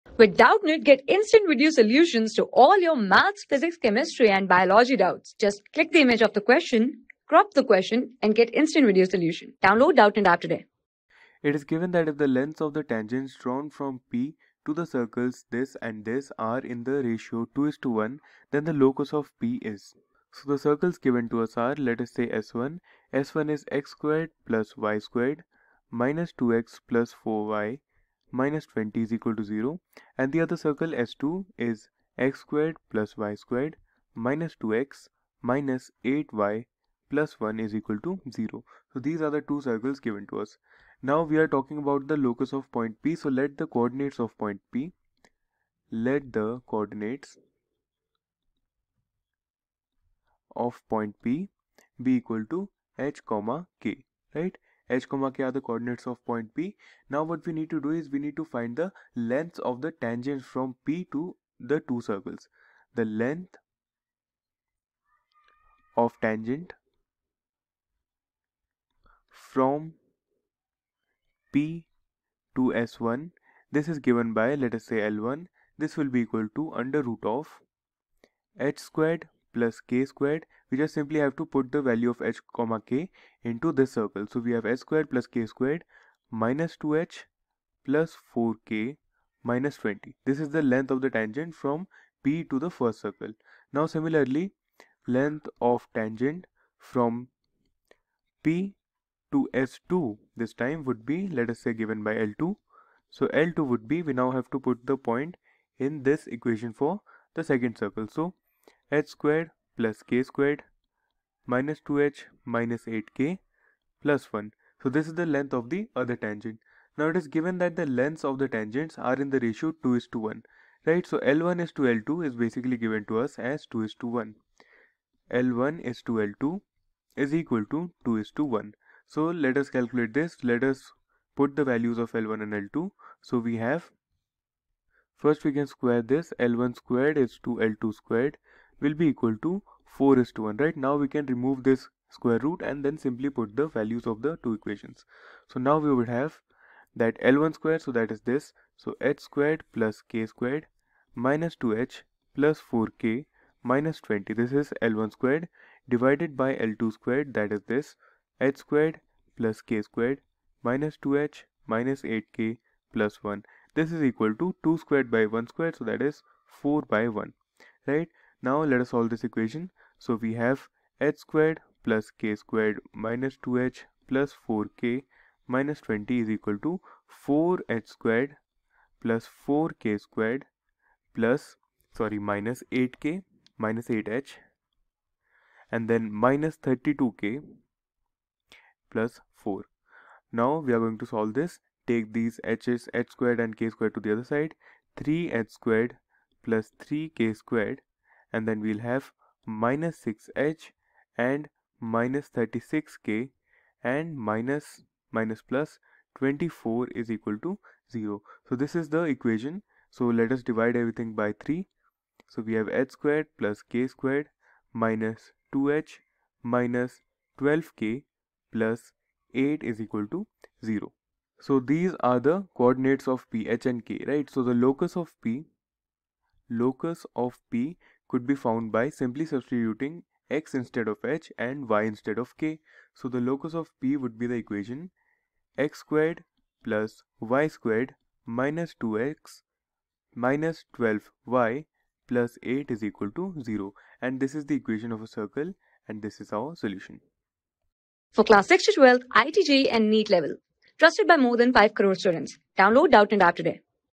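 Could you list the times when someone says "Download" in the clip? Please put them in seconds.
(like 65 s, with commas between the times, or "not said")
9 s, 252 s.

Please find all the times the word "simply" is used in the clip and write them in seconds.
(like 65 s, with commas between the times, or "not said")
80 s, 142 s, 228 s.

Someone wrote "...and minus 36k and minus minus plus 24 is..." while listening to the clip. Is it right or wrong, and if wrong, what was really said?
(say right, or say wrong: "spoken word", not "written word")
right.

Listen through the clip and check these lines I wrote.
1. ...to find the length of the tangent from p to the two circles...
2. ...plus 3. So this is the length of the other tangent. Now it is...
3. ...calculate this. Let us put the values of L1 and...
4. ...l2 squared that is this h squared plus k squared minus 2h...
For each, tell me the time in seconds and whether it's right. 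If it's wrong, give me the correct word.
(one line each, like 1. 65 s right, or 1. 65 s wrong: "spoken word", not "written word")
1. 58 s right
2. 114 s wrong: "1", not "3"
3. 129 s right
4. 156 s right.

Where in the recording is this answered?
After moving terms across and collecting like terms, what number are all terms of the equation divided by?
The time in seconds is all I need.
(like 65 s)
210 s.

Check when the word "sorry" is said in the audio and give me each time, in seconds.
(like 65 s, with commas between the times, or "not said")
181 s.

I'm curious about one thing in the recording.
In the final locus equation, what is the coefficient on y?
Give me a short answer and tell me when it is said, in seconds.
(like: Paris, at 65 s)
-12, at 240 s.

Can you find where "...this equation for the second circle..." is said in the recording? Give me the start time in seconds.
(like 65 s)
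106 s.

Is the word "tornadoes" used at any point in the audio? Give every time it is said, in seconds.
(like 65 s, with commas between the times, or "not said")
not said.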